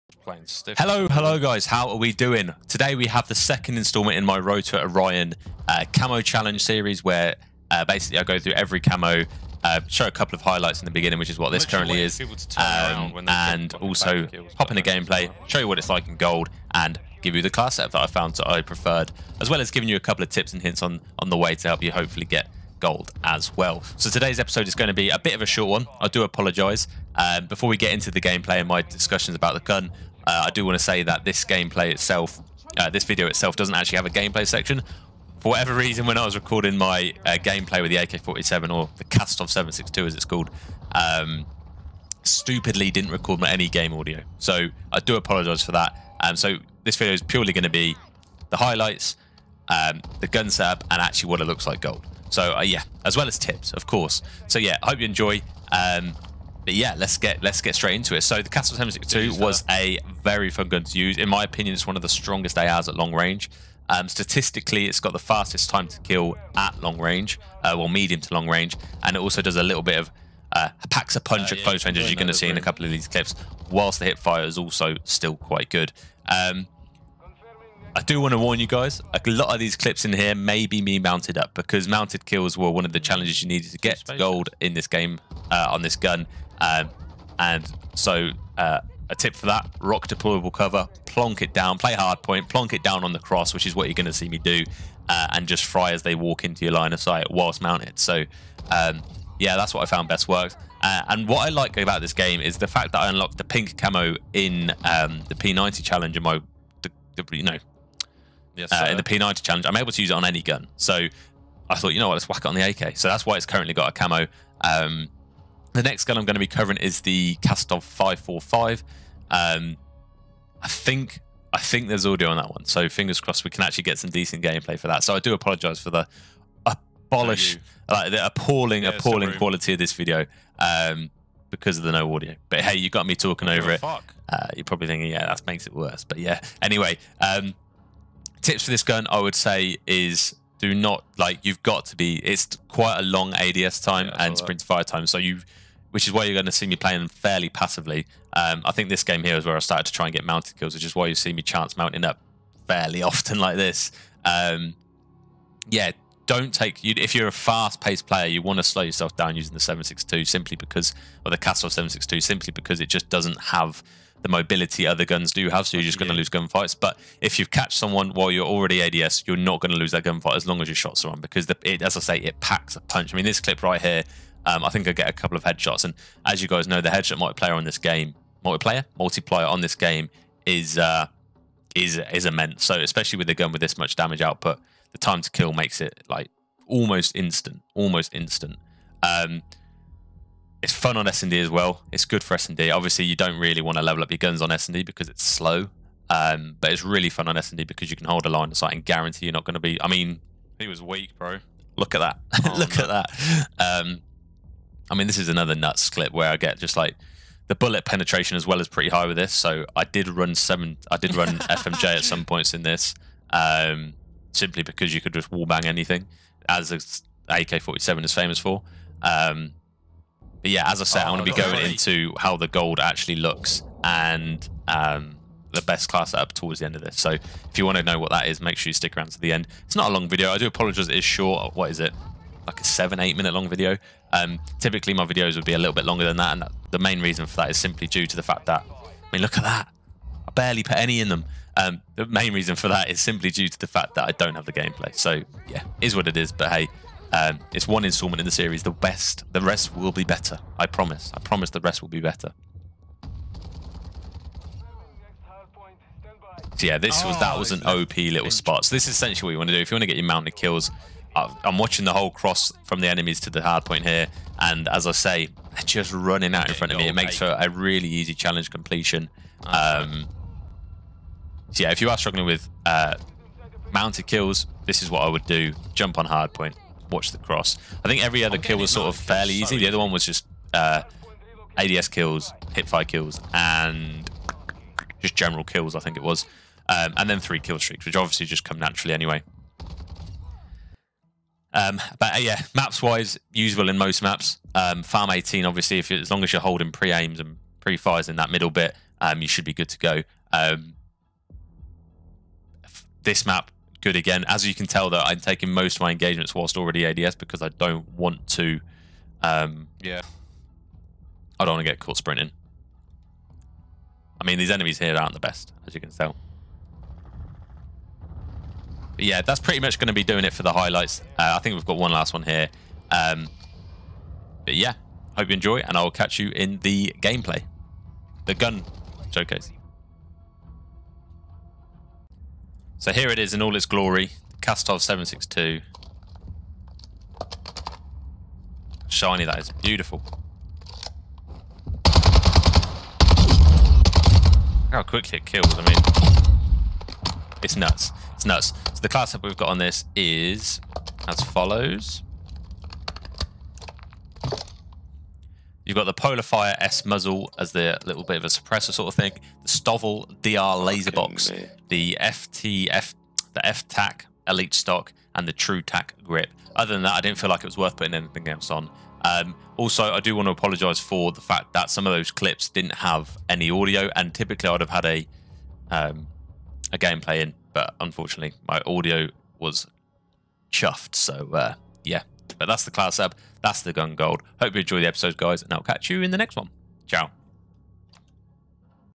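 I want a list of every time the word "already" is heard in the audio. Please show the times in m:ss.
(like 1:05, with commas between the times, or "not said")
2:48, 5:06.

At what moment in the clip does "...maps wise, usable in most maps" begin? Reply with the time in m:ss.
4:52.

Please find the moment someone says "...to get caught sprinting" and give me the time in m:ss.
5:11.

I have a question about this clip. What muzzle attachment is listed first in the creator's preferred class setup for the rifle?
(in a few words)
Polar Fire S.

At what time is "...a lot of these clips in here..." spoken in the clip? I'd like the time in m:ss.
1:19.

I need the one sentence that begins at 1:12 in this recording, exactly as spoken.
in a couple of these clips, whilst the hip fire is also still quite good.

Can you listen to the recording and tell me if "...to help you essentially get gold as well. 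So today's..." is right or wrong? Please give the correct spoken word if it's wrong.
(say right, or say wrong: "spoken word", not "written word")
wrong: "hopefully", not "essentially".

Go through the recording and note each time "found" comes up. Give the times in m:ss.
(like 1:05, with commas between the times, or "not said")
0:18, 1:39.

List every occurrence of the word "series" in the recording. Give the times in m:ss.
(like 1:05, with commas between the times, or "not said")
0:06, 4:08.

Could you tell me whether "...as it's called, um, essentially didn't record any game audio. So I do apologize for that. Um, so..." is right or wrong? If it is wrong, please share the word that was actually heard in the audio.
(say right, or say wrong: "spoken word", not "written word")
wrong: "stupidly", not "essentially".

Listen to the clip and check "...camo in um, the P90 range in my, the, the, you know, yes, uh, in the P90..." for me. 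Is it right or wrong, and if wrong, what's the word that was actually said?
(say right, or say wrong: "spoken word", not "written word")
wrong: "challenge", not "range".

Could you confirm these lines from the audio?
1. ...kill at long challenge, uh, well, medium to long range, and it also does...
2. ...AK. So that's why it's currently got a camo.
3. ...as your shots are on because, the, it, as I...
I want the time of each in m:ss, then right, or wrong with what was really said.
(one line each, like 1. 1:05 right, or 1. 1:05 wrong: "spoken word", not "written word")
1. 1:06 wrong: "range", not "challenge"
2. 1:52 right
3. 2:50 right.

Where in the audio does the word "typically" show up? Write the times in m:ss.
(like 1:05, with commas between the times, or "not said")
3:54, 6:14.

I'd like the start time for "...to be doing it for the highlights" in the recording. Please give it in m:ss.
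5:19.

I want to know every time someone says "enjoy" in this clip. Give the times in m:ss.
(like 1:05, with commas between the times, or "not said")
0:55, 5:25, 6:24.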